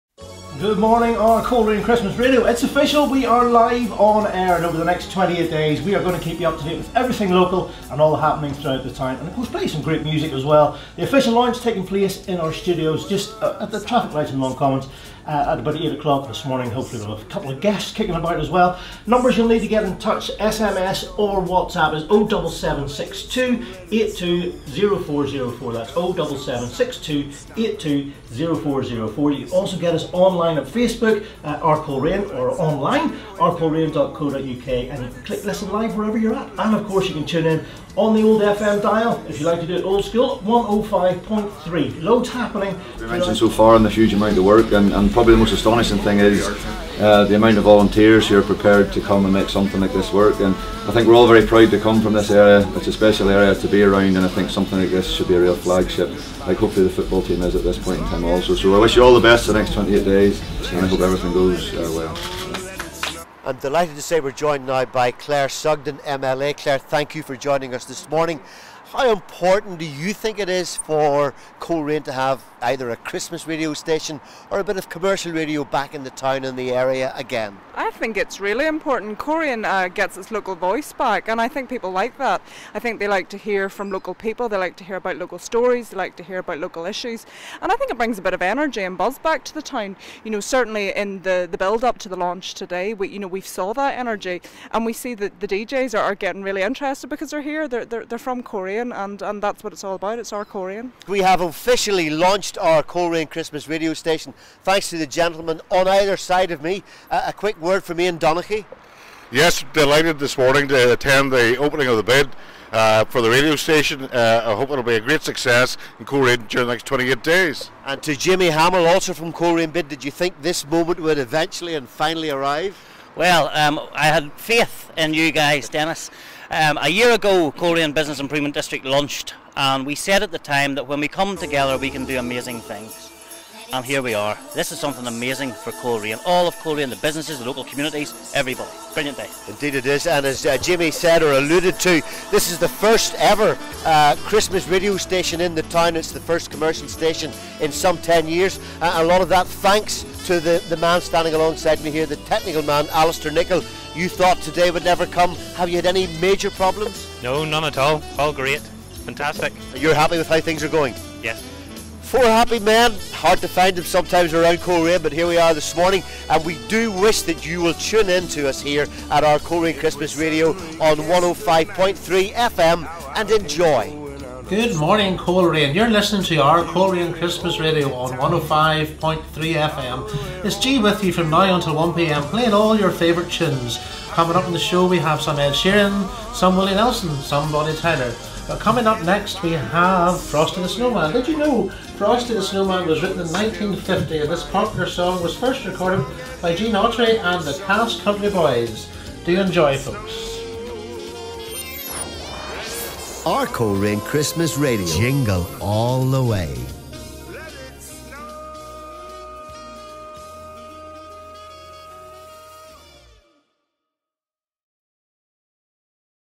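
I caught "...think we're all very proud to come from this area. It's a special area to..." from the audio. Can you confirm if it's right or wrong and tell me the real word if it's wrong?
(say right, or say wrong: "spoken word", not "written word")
right.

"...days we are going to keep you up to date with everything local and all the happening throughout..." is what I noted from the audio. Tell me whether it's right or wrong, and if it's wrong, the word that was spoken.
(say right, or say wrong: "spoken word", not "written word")
right.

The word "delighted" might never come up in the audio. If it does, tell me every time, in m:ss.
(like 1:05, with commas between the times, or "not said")
1:03, 1:49.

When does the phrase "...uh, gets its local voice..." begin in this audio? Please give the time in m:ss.
1:19.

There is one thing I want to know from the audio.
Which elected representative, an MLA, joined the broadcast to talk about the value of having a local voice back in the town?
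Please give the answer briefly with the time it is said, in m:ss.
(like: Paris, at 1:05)
Claire Sugden, at 1:05.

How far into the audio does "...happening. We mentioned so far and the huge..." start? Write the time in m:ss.
0:42.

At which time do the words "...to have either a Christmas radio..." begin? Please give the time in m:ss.
1:12.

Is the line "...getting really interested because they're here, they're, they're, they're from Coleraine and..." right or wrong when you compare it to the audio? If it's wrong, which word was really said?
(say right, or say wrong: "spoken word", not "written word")
right.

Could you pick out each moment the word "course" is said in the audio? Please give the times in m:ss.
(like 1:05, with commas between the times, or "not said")
0:09, 0:36.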